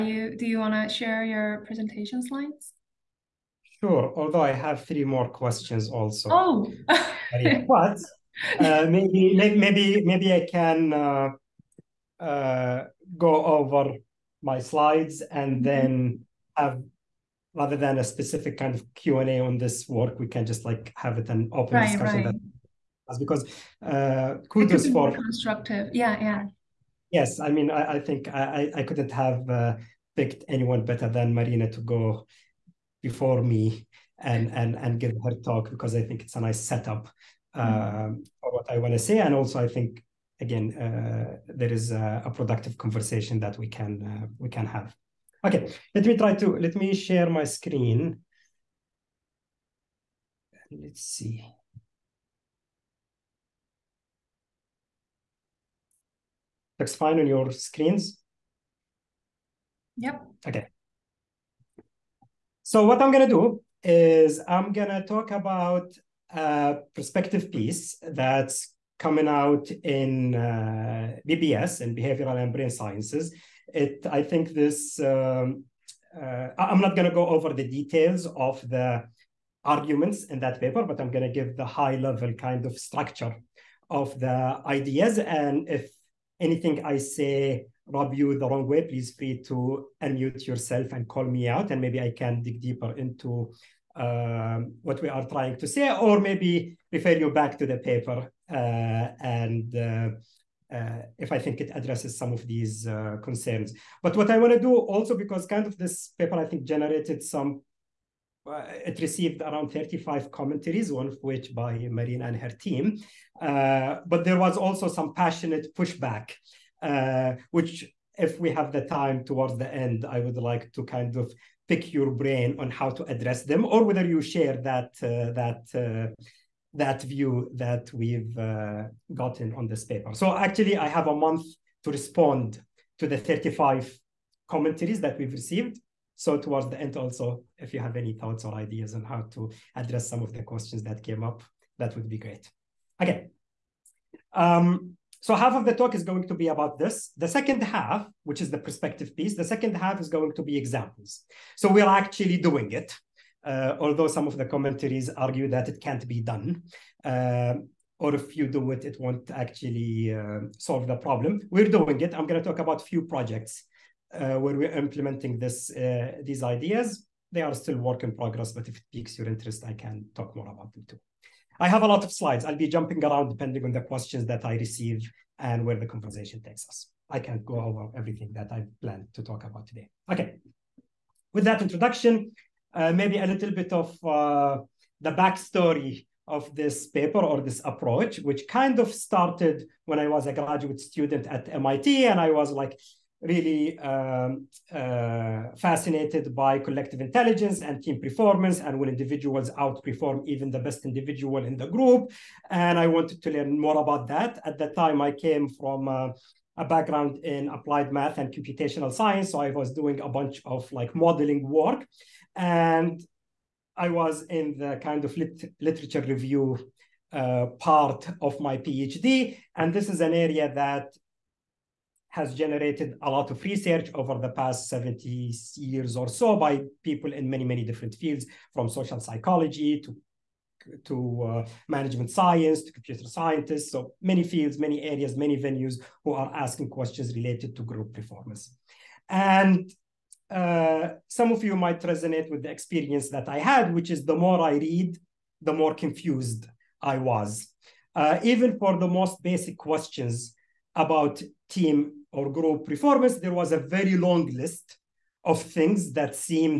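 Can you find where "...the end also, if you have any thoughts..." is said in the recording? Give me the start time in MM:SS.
02:16.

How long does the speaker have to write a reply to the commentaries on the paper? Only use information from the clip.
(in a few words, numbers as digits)
a month.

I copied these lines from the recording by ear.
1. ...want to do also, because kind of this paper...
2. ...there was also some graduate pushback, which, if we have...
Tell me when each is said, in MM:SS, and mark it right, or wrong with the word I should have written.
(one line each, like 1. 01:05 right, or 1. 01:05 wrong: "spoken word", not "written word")
1. 01:44 right
2. 01:54 wrong: "passionate", not "graduate".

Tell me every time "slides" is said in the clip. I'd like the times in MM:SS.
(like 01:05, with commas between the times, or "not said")
00:02, 00:14, 02:52.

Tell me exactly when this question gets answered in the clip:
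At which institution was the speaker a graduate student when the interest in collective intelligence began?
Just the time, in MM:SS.
03:11.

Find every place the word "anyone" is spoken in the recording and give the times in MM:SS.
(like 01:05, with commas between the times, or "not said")
00:30.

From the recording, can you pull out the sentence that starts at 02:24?
Um, so half of the talk is going to be about this.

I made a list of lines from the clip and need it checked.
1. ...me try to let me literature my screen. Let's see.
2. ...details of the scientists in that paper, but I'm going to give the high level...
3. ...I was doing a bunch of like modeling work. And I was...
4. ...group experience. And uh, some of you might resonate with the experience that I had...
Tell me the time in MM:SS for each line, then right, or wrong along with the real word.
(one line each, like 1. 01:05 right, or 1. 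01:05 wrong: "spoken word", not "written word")
1. 00:46 wrong: "share", not "literature"
2. 01:17 wrong: "arguments", not "scientists"
3. 03:29 right
4. 03:57 wrong: "performance", not "experience".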